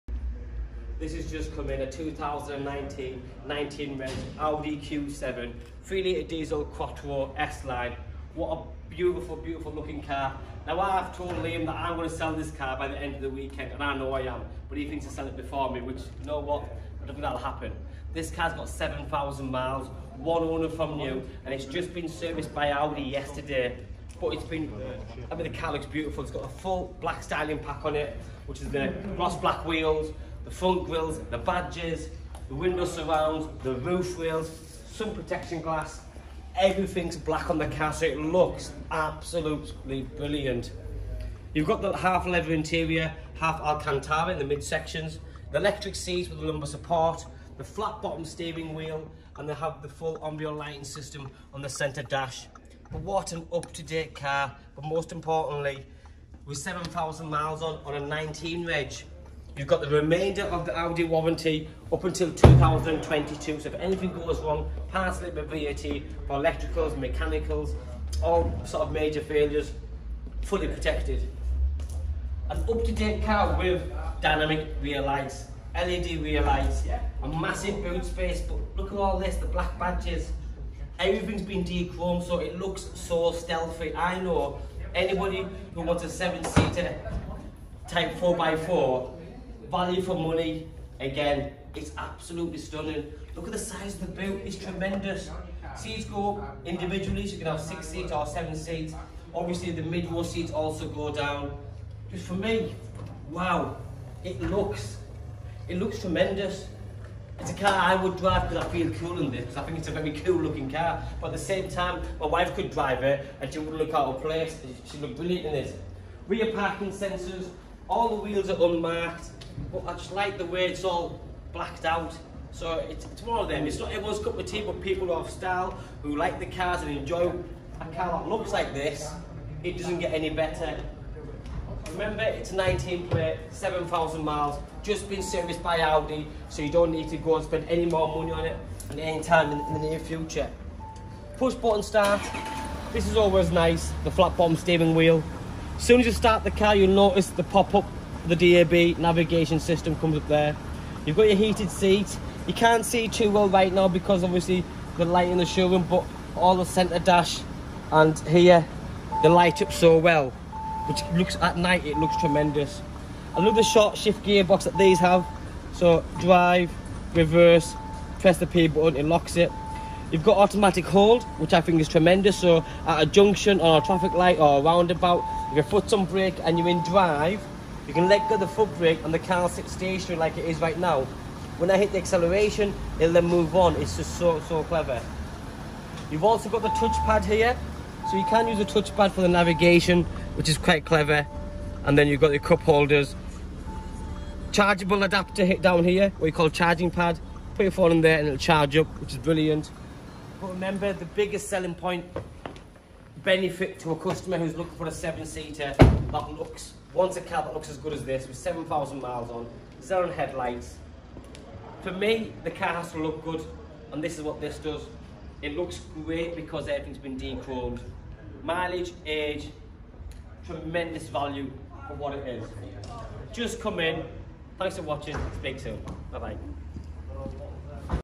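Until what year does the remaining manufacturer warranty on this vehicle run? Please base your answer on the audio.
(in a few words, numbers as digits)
2022.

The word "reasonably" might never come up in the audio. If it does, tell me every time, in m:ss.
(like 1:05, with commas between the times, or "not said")
not said.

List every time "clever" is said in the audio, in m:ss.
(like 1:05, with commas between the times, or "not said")
3:04, 3:10.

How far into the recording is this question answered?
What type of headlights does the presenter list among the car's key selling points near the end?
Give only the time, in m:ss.
3:29.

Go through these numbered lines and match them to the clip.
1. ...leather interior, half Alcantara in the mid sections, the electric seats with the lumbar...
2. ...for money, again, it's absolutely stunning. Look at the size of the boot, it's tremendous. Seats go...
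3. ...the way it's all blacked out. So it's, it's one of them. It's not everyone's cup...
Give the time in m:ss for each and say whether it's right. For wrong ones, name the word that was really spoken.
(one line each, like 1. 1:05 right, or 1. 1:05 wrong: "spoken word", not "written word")
1. 0:42 right
2. 1:30 right
3. 2:00 right.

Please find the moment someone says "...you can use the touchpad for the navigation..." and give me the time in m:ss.
3:08.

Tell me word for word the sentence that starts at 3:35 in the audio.
It looks great because everything's been dechromed.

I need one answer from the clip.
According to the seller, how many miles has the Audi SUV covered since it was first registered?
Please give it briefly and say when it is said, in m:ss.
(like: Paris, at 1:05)
7,000, at 0:18.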